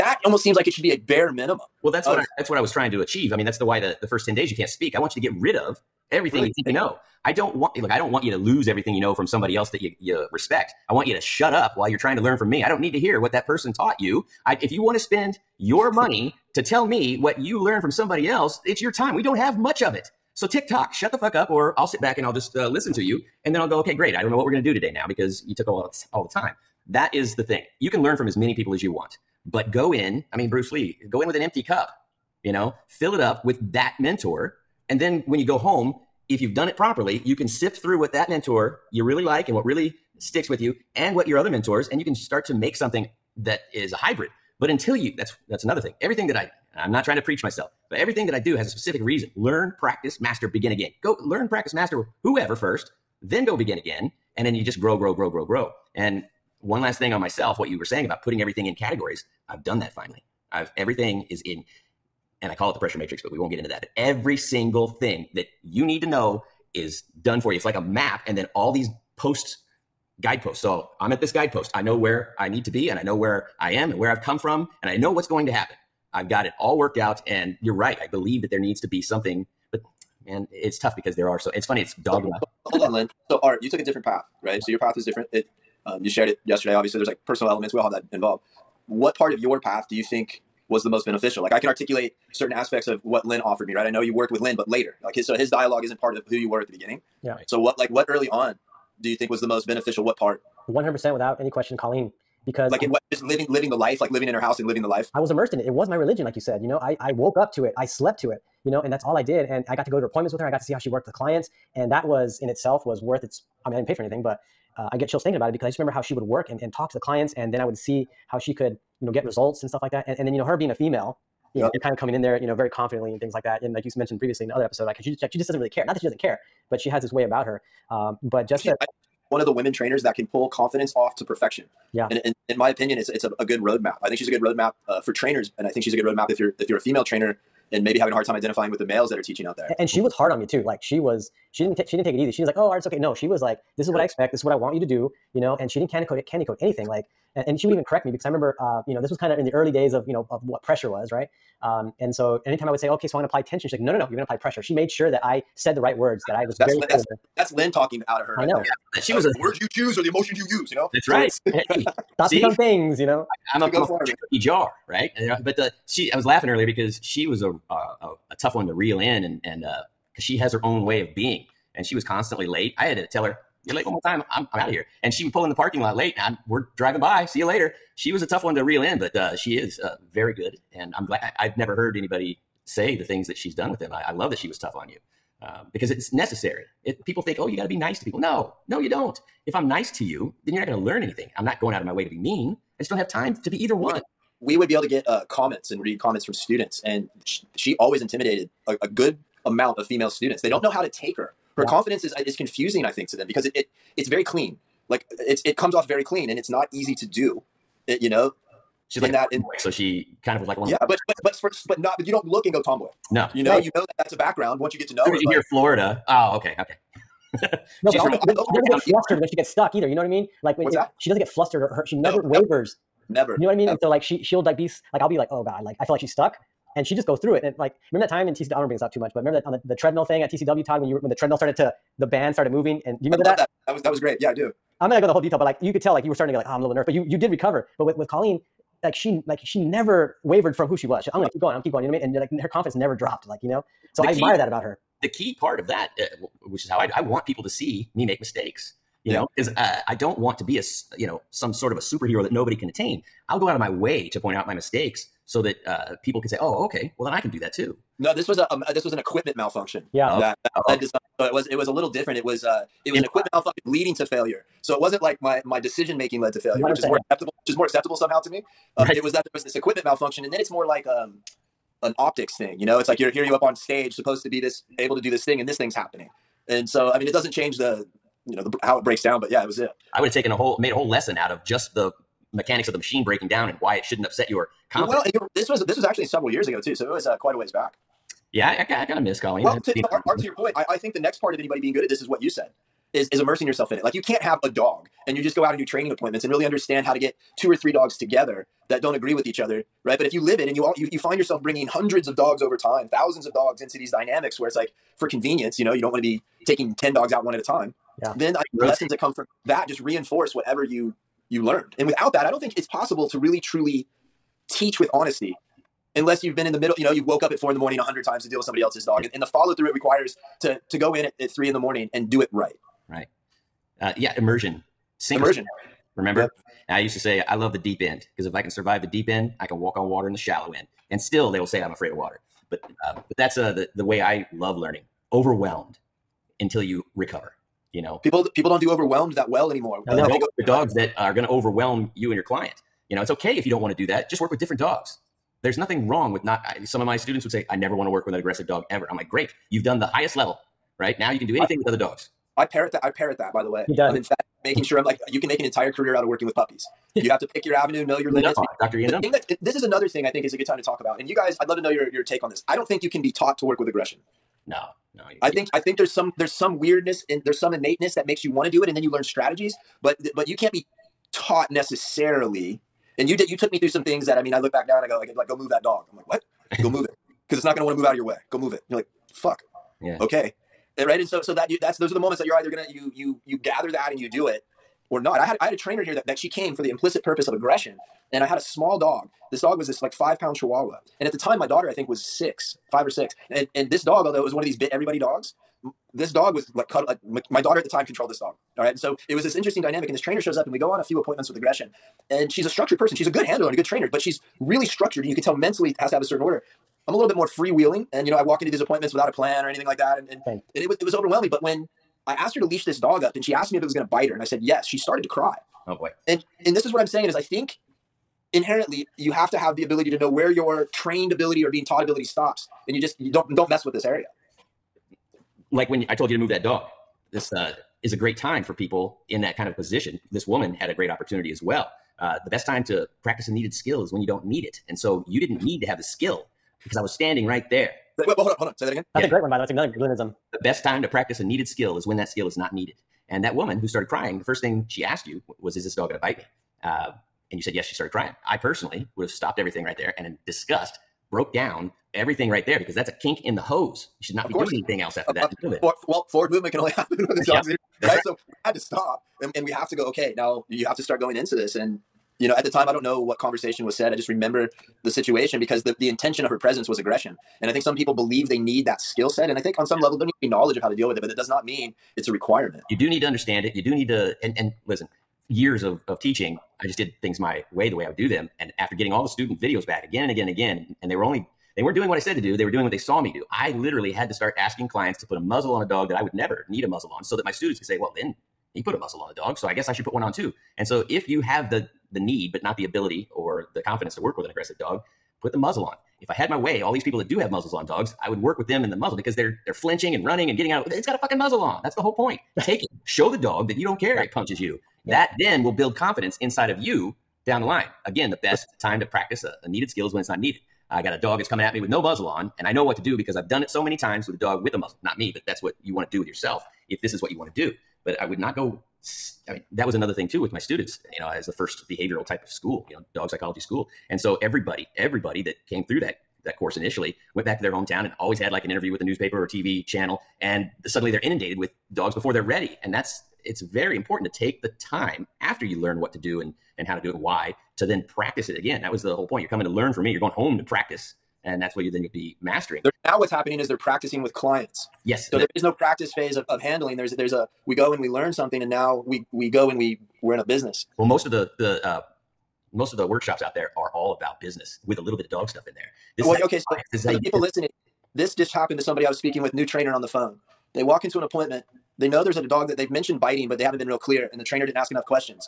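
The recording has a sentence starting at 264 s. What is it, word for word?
So it wasn't like my my decision making led to failure, which is more acceptable, which is more acceptable somehow to me.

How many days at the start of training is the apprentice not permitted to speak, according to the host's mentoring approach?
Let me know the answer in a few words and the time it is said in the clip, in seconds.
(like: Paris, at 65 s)
10, at 4 s.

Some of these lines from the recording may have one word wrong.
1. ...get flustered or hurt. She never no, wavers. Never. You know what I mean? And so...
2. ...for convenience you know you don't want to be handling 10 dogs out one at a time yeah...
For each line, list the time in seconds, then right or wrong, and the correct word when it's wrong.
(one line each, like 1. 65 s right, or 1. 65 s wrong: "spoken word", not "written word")
1. 221 s right
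2. 304 s wrong: "taking", not "handling".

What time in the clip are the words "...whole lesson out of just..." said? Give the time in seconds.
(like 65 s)
280 s.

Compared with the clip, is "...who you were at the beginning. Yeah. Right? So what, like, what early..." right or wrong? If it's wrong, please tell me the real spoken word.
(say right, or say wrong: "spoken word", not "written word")
right.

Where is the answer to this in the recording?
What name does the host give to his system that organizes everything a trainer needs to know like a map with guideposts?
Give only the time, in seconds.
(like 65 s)
62 s.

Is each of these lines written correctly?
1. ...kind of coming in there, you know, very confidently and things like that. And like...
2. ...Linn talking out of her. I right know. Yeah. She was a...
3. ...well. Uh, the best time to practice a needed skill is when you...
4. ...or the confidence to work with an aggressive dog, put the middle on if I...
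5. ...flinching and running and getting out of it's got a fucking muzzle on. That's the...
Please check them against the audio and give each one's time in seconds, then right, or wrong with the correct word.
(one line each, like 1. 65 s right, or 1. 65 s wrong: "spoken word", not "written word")
1. 121 s right
2. 157 s right
3. 431 s right
4. 493 s wrong: "muzzle", not "middle"
5. 499 s right.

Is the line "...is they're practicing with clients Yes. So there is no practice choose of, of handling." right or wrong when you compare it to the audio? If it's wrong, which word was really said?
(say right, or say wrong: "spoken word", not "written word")
wrong: "phase", not "choose".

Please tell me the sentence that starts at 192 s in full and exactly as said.
I just don't have time to be either one.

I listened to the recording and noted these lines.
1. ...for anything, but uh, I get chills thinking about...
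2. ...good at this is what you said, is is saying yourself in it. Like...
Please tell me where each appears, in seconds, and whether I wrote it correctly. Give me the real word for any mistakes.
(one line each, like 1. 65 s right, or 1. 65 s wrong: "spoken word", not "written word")
1. 113 s right
2. 291 s wrong: "immersing", not "saying".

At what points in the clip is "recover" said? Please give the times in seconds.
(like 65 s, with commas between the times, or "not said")
237 s, 336 s.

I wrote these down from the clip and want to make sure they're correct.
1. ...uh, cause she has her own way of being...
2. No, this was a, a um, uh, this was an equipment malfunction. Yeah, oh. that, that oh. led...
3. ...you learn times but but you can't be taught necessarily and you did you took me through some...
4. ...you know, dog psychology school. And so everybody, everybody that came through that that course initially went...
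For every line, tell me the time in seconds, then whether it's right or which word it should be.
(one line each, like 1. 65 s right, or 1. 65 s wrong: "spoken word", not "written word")
1. 169 s right
2. 258 s right
3. 368 s wrong: "strategies", not "times"
4. 522 s right.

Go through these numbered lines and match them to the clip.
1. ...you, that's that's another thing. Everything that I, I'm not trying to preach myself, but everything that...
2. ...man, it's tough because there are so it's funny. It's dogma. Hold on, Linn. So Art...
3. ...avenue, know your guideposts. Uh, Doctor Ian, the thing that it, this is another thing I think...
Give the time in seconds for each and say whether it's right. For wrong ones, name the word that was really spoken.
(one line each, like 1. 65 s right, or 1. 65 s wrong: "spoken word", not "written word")
1. 44 s right
2. 80 s right
3. 357 s wrong: "limits", not "guideposts".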